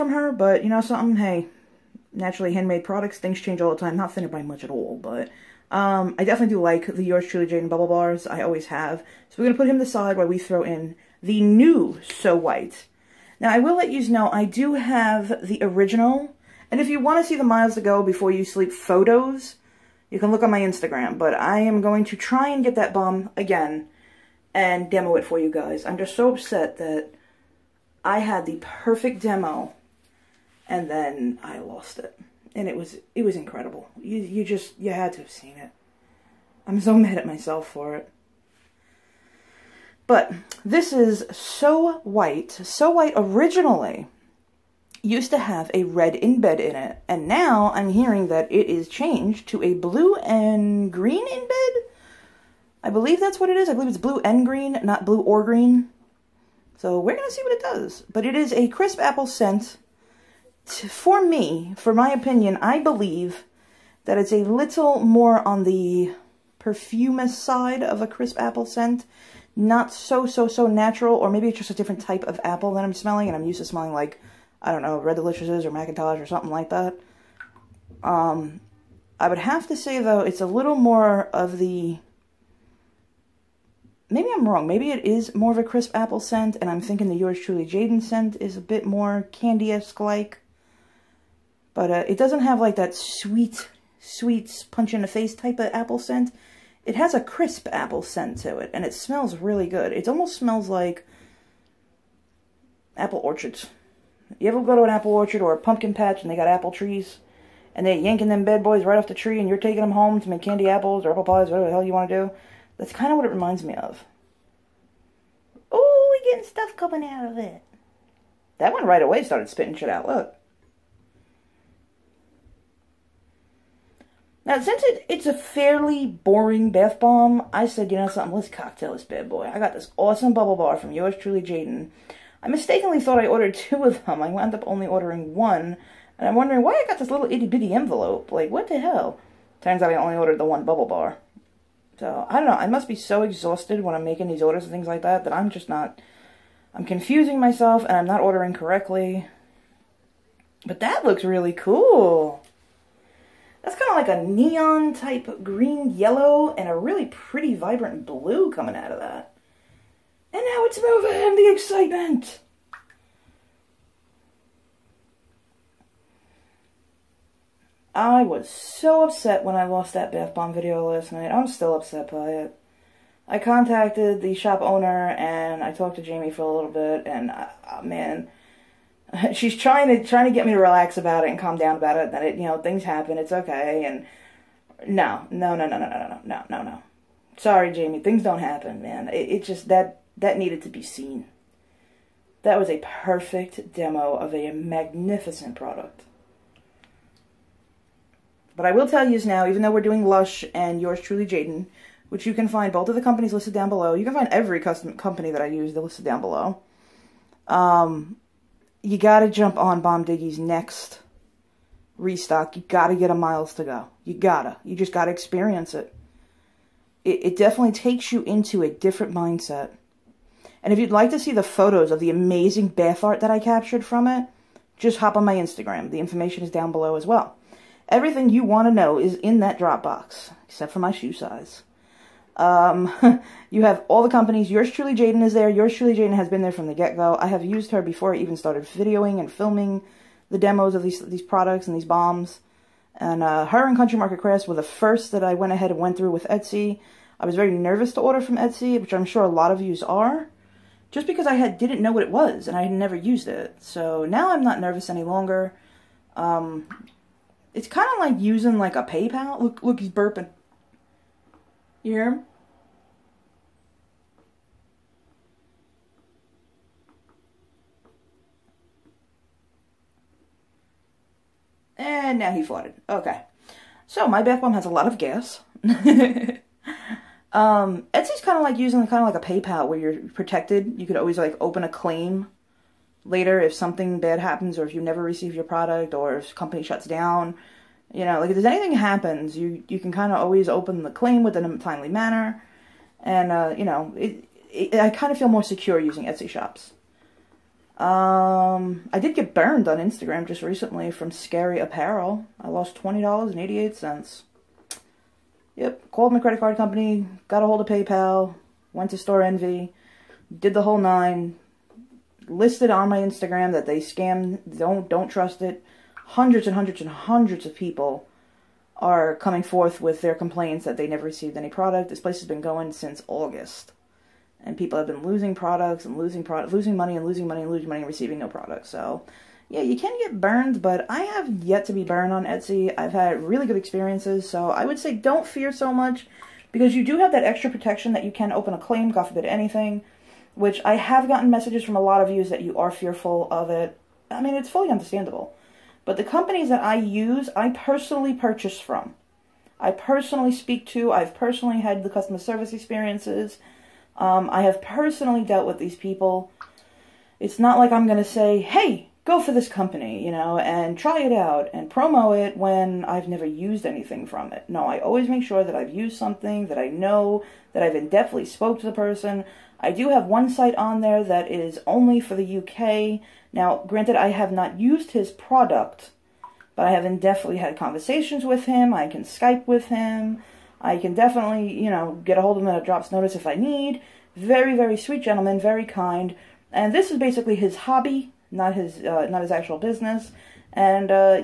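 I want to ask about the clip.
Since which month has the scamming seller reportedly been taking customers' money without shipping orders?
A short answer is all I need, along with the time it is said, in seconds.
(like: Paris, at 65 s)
August, at 323 s.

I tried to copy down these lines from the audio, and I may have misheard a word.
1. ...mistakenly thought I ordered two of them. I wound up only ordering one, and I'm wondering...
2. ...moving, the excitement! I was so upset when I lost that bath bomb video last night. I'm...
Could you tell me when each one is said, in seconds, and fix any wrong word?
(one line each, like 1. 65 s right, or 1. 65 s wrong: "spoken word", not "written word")
1. 132 s right
2. 160 s right.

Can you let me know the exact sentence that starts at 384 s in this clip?
Very, very sweet gentleman, very kind.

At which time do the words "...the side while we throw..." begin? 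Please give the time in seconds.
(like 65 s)
9 s.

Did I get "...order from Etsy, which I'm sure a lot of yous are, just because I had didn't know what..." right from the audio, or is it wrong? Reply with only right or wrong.
right.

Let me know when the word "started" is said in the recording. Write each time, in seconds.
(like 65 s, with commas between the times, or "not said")
119 s, 238 s.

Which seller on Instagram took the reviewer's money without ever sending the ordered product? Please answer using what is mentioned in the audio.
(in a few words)
Scary Apparel.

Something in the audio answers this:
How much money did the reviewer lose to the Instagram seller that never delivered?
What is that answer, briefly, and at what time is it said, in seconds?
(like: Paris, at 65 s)
$20.88, at 302 s.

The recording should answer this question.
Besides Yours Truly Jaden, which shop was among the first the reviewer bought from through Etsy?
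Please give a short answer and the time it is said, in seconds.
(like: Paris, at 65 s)
Country Market Crafts, at 243 s.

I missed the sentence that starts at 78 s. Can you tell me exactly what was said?
Um, I would have to say, though, it's a little more of the...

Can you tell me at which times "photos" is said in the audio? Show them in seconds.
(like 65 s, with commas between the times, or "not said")
18 s, 221 s.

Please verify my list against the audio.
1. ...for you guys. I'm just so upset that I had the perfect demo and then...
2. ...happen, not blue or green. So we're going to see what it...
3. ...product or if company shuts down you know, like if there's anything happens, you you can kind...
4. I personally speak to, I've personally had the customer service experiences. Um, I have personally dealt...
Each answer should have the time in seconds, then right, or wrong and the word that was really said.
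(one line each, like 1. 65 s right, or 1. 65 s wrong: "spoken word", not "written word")
1. 25 s right
2. 54 s wrong: "green", not "happen"
3. 285 s right
4. 349 s right.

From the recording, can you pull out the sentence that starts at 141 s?
So, I don't know, I must be so exhausted when I'm making these orders and things like that that I'm just not...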